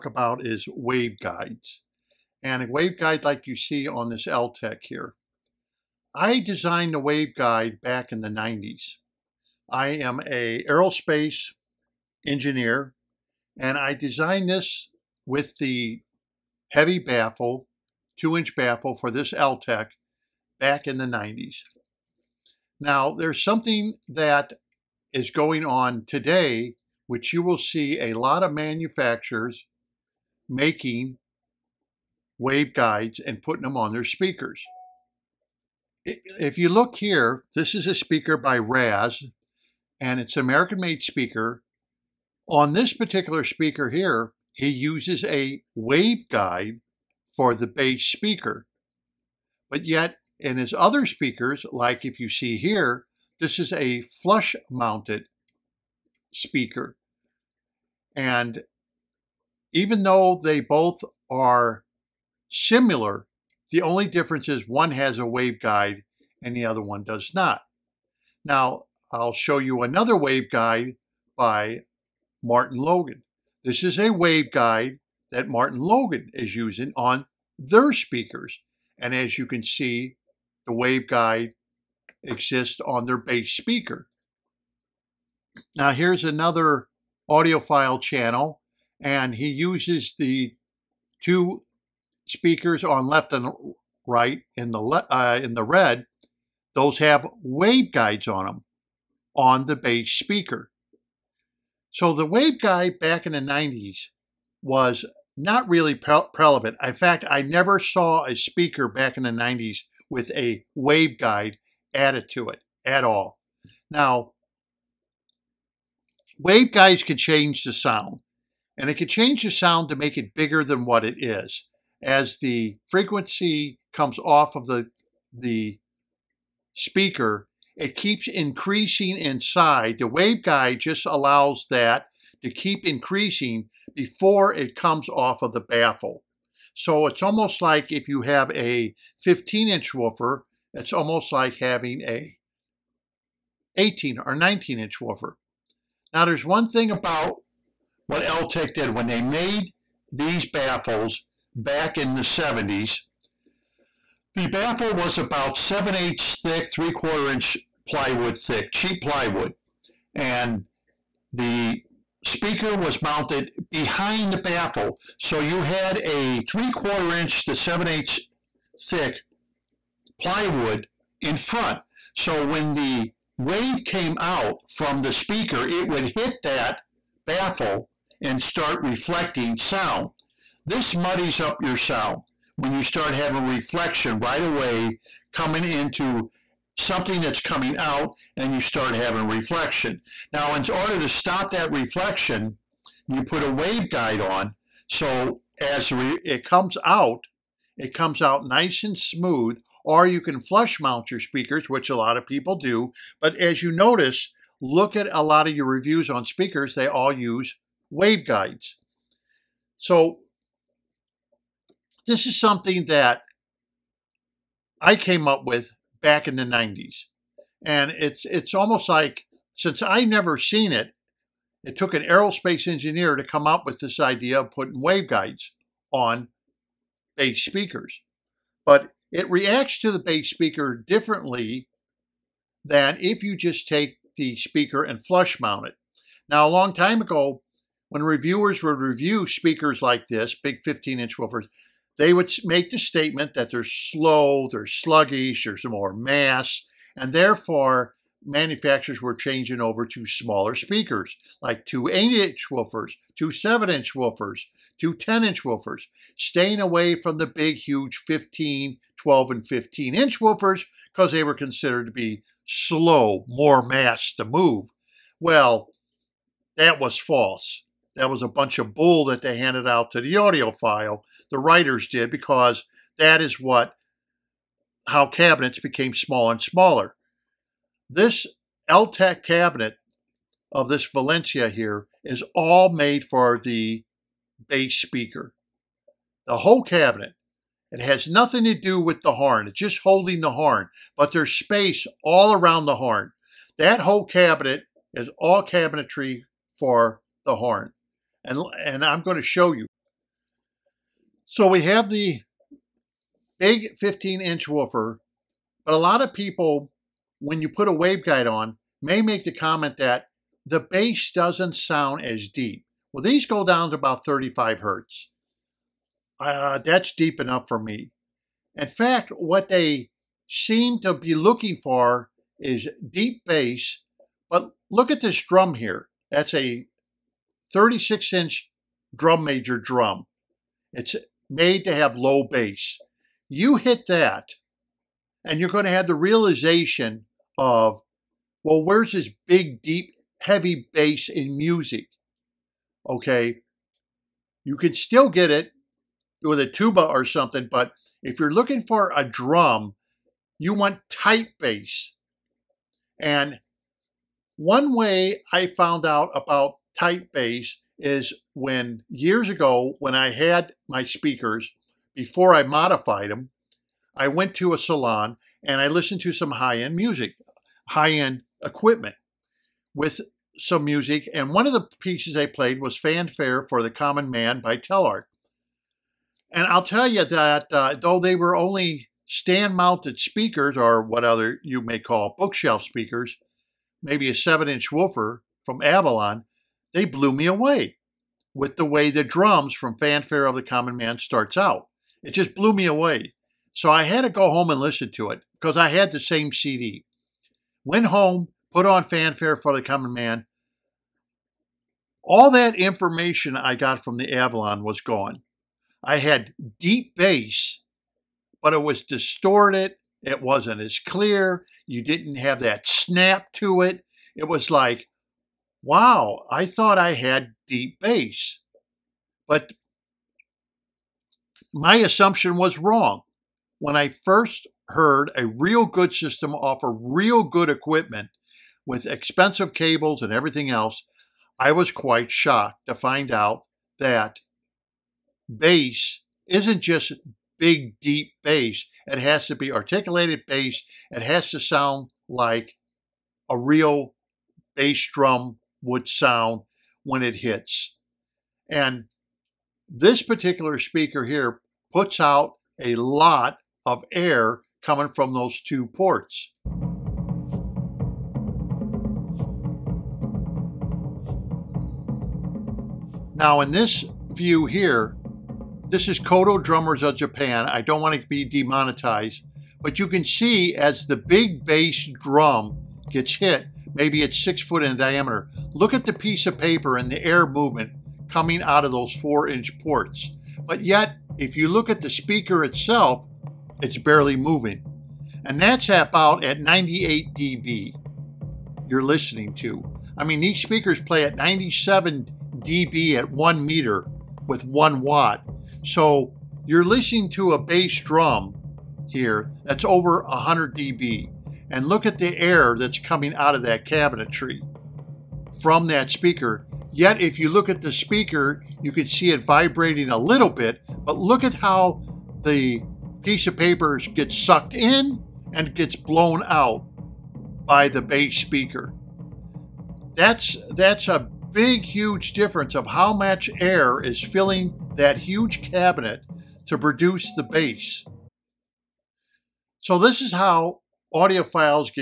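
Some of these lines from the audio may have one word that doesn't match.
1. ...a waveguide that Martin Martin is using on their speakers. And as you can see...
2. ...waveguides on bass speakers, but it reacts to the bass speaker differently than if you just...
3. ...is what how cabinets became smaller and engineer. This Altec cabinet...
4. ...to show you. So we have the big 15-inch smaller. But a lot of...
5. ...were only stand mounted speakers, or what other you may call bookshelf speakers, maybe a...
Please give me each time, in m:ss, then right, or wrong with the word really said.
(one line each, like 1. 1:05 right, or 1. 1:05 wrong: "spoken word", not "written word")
1. 1:13 wrong: "Logan", not "Martin"
2. 3:44 right
3. 4:33 wrong: "smaller", not "engineer"
4. 4:59 wrong: "woofer", not "smaller"
5. 6:18 right.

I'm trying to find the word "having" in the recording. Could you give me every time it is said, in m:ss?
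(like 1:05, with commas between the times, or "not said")
2:21, 3:03, 3:08.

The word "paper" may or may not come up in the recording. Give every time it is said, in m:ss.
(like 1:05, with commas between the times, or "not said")
7:56, 8:33.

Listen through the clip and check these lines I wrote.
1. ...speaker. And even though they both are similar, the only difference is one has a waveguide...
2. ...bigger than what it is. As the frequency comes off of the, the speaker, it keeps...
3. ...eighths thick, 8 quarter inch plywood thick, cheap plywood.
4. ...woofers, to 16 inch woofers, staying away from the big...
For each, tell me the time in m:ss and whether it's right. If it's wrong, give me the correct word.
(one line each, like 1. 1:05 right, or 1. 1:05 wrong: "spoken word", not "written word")
1. 0:56 right
2. 2:00 right
3. 2:35 wrong: "3", not "8"
4. 4:13 wrong: "10", not "16".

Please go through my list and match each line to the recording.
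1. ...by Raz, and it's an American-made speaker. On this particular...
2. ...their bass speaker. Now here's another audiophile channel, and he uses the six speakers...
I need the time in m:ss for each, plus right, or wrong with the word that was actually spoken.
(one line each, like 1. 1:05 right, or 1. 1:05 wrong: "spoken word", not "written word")
1. 0:38 right
2. 1:23 wrong: "two", not "six".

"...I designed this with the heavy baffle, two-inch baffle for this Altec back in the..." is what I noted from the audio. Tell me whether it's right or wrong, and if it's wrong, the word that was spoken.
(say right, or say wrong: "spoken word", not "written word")
right.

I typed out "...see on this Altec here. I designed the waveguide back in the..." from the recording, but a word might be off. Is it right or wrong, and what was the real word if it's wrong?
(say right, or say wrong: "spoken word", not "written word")
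right.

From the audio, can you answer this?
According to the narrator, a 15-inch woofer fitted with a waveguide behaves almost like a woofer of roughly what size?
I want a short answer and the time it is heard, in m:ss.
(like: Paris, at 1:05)
18 or 19 inch, at 2:23.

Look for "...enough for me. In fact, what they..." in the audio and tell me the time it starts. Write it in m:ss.
5:17.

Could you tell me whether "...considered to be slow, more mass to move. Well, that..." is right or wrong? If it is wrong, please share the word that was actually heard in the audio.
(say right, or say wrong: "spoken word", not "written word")
right.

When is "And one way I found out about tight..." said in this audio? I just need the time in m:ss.
5:53.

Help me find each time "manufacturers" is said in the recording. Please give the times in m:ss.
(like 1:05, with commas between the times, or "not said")
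0:28, 4:08.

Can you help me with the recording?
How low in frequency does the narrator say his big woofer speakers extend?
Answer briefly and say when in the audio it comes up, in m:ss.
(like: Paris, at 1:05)
35 Hz, at 5:14.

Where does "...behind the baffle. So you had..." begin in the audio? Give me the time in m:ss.
2:43.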